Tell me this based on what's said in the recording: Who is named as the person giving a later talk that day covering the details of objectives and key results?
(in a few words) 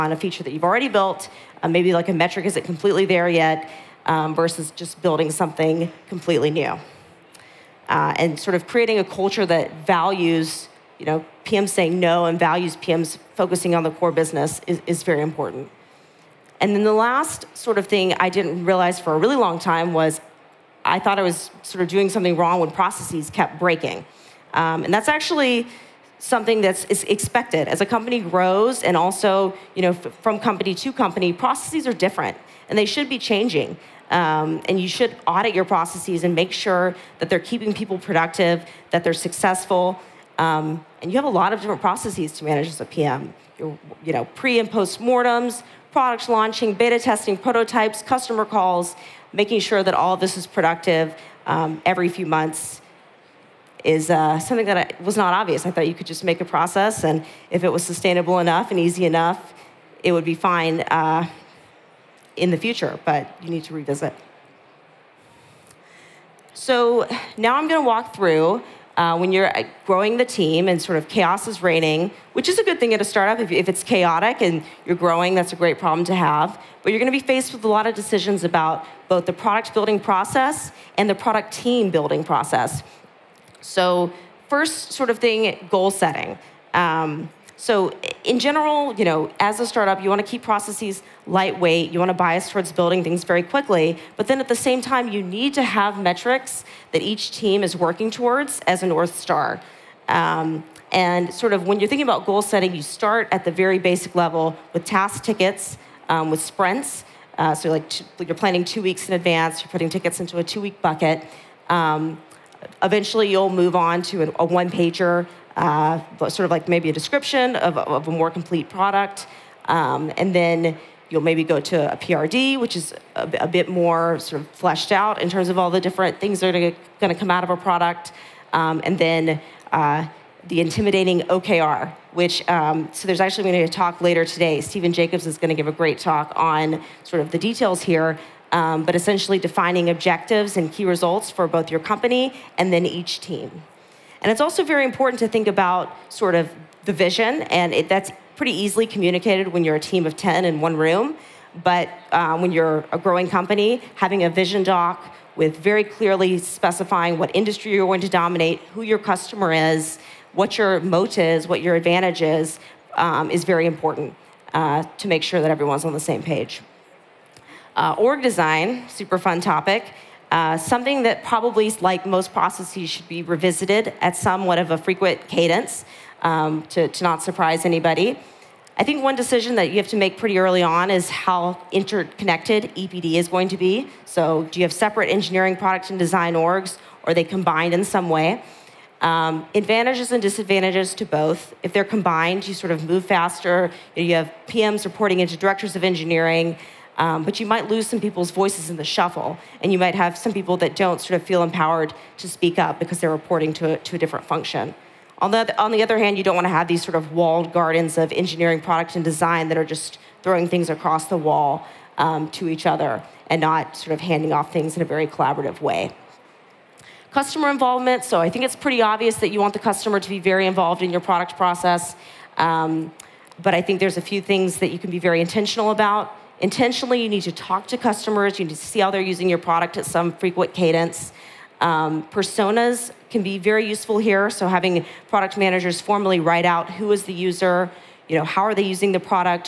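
Stephen Jacobs.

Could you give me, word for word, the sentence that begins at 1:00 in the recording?
Uh, in the future, but you need to revisit.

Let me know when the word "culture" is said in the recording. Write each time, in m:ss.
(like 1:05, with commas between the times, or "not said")
0:09.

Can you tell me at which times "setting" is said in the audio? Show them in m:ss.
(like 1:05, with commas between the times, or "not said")
1:25, 1:42.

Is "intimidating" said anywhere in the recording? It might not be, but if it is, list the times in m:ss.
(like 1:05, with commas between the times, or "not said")
2:10.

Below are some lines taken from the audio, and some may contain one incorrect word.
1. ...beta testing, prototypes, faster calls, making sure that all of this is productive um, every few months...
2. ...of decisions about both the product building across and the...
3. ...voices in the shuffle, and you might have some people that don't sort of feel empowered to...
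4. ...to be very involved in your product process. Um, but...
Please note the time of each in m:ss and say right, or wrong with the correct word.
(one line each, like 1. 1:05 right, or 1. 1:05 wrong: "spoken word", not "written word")
1. 0:46 wrong: "customer", not "faster"
2. 1:17 wrong: "process", not "across"
3. 3:18 right
4. 3:39 right.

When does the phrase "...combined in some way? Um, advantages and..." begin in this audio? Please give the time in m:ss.
3:07.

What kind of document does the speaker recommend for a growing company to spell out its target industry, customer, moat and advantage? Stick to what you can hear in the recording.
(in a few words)
vision doc.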